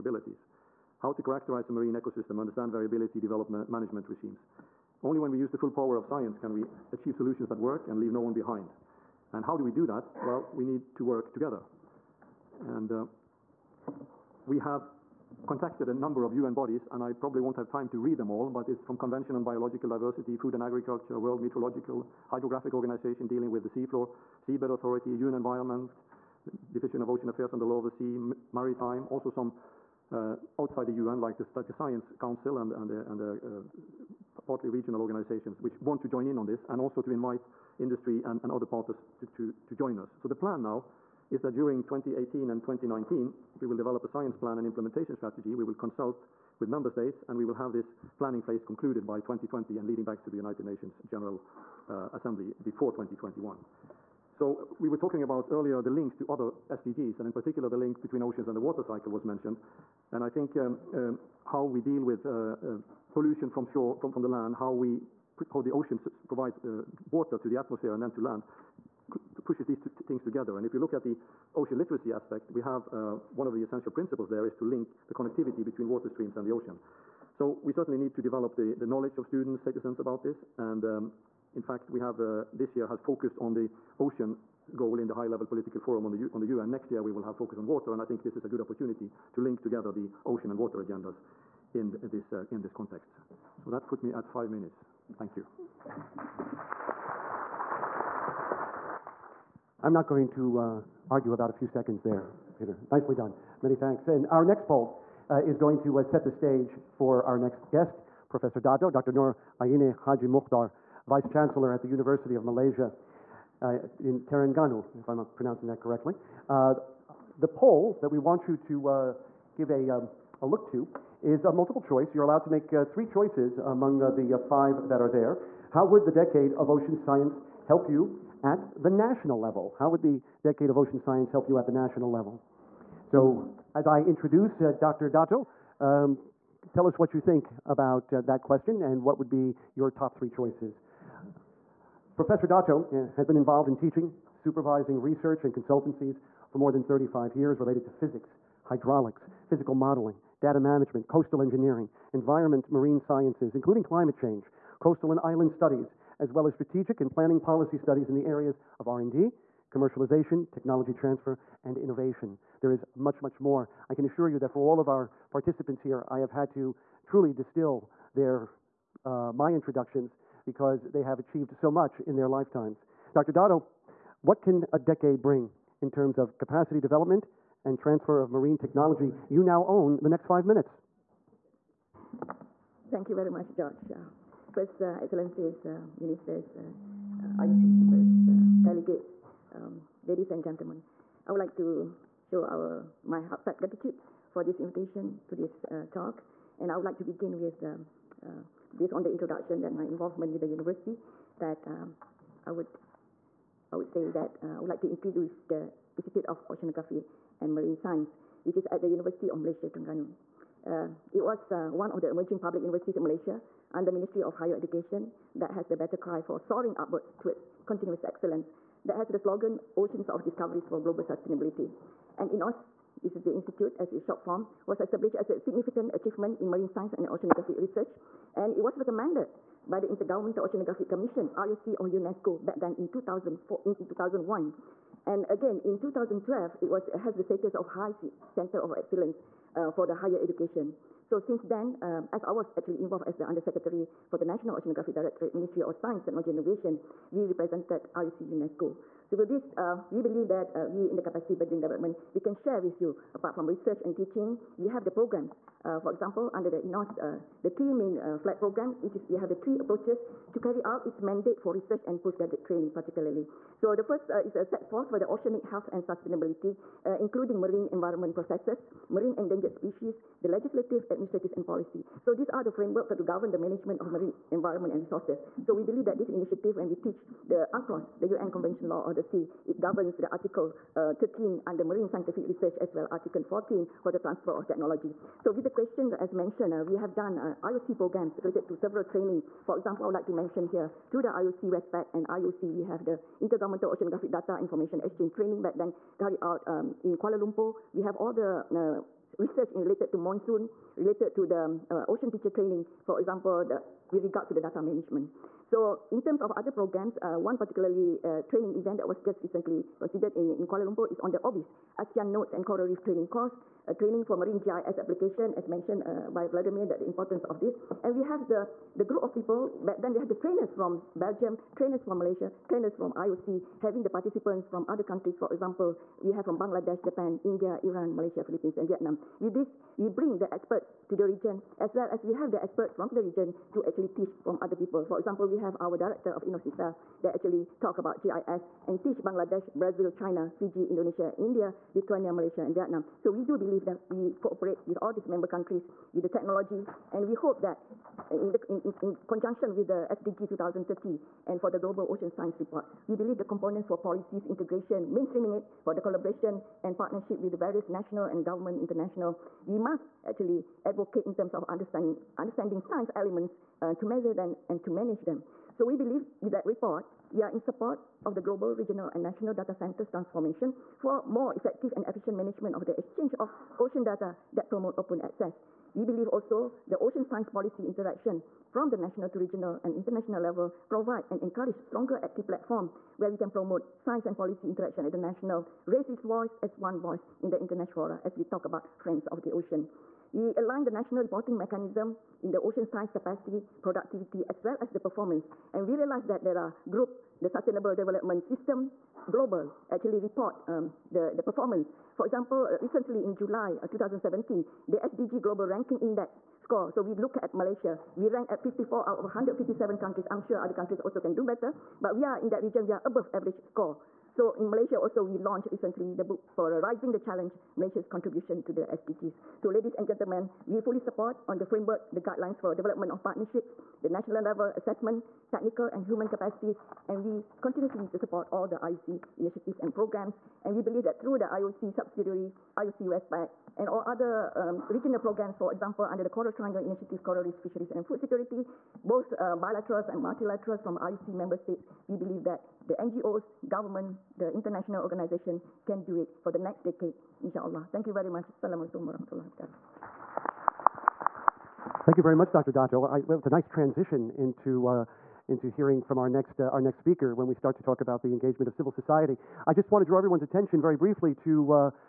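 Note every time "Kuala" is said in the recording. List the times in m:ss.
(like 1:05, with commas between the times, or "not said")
4:56, 5:10.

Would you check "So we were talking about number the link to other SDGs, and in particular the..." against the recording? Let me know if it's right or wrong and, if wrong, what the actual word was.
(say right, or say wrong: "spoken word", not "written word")
wrong: "earlier", not "number".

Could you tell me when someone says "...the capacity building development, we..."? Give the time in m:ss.
4:10.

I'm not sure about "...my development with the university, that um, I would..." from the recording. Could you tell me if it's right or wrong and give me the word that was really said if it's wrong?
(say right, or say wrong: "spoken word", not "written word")
wrong: "involvement", not "development".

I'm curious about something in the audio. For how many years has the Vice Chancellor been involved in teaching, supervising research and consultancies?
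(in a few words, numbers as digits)
35.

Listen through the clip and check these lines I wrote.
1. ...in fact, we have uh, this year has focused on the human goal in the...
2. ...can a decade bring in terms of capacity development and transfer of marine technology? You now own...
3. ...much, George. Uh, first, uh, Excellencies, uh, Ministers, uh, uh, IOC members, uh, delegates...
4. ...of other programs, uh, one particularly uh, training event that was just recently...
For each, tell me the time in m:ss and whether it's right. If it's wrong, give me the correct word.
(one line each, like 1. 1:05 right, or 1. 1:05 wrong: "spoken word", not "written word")
1. 1:21 wrong: "ocean", not "human"
2. 2:54 right
3. 3:03 right
4. 5:06 right.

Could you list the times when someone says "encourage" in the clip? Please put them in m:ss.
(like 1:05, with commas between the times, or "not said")
6:21.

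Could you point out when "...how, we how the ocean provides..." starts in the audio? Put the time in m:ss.
1:04.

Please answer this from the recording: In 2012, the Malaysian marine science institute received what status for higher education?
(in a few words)
High Center of Excellence.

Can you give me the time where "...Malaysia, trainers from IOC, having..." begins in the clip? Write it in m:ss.
5:21.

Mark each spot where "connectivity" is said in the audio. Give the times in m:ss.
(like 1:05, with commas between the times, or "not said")
1:15.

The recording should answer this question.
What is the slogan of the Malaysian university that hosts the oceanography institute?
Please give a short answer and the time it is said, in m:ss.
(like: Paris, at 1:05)
Oceans of Discoveries for Global Sustainability, at 3:39.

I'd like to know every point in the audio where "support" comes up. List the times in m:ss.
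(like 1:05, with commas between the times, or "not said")
6:07, 7:00, 7:07.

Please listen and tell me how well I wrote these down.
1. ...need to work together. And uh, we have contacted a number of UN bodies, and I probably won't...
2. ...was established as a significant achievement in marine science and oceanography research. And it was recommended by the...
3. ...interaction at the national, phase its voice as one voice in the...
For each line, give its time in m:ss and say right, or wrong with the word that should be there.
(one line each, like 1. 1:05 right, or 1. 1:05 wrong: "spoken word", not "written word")
1. 0:10 right
2. 3:44 right
3. 6:24 wrong: "raise", not "phase".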